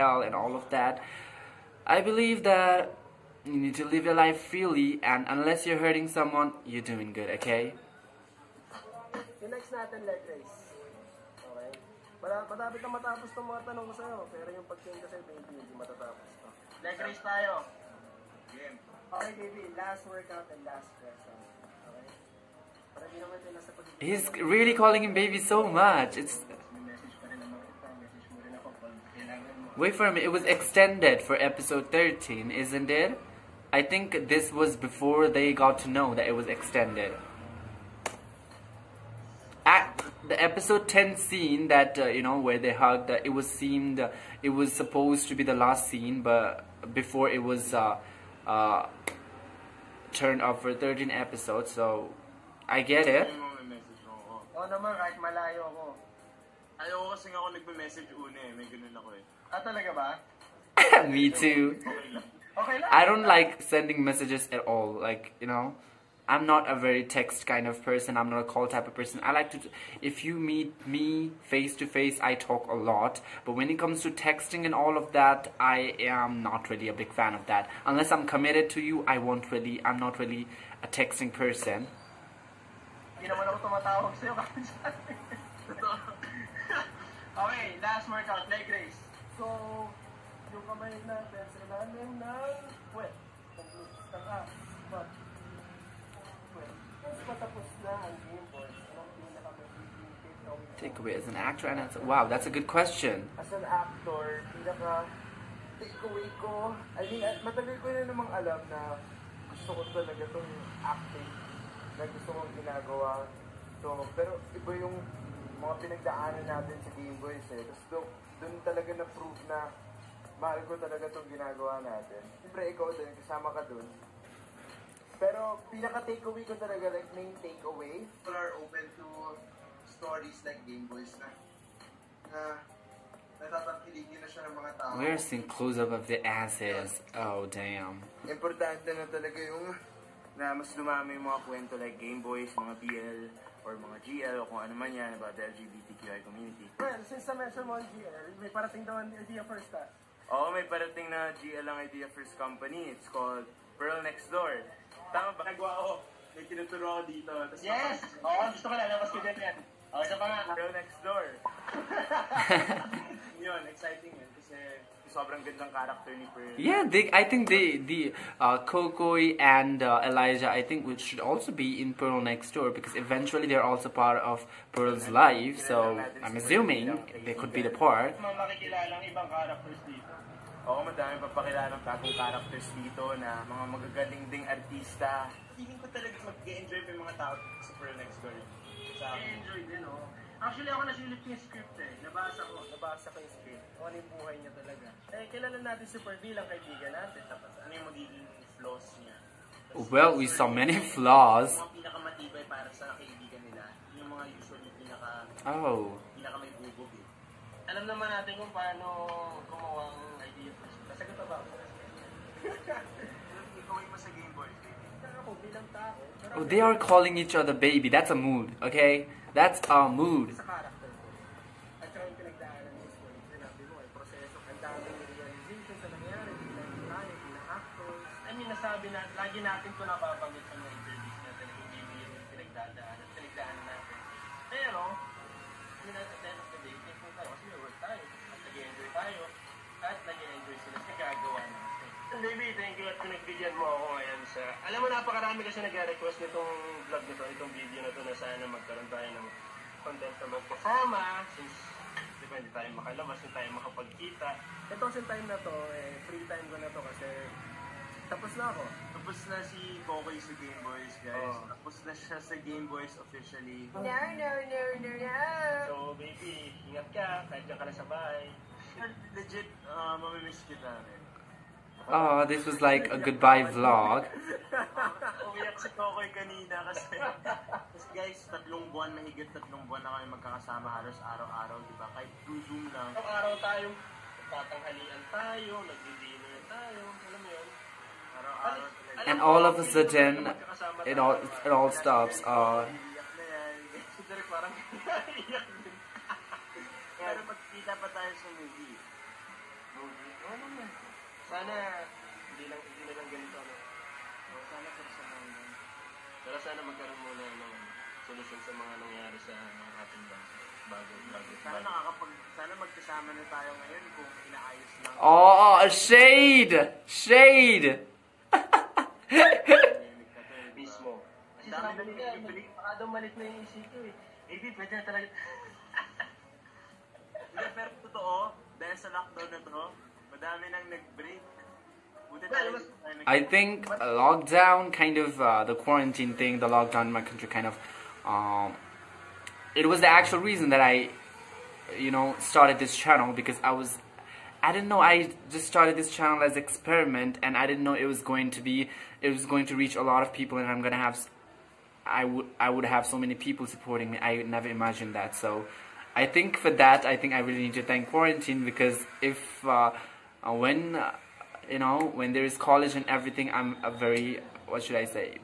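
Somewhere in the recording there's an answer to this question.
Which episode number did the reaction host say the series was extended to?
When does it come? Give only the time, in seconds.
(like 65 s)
31 s.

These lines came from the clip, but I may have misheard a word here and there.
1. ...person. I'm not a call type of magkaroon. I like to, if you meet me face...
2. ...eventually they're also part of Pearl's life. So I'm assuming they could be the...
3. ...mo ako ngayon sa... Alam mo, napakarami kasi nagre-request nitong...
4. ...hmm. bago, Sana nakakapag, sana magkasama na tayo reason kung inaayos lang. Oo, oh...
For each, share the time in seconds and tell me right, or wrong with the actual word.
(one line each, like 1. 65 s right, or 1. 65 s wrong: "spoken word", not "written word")
1. 67 s wrong: "person", not "magkaroon"
2. 172 s right
3. 243 s right
4. 310 s wrong: "ngayon", not "reason".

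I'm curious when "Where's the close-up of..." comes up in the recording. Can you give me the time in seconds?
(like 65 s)
134 s.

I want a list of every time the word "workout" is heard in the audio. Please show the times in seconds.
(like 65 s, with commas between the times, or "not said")
20 s, 88 s.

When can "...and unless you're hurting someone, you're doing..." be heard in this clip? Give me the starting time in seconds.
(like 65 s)
5 s.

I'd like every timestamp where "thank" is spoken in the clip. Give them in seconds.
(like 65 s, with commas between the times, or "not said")
242 s, 357 s.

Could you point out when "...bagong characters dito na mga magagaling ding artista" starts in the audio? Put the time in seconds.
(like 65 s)
181 s.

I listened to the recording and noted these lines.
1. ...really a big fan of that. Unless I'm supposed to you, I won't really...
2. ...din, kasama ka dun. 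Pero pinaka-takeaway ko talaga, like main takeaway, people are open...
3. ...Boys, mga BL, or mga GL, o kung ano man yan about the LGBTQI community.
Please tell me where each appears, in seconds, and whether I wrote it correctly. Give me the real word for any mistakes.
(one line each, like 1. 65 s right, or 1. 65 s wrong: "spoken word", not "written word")
1. 76 s wrong: "committed", not "supposed"
2. 122 s right
3. 142 s right.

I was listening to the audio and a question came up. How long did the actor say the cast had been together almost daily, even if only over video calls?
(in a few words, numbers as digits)
Over 3 months.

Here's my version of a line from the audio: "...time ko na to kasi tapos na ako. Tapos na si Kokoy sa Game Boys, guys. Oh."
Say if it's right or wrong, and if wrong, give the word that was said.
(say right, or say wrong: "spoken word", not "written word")
right.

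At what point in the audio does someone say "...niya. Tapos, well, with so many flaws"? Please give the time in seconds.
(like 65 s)
198 s.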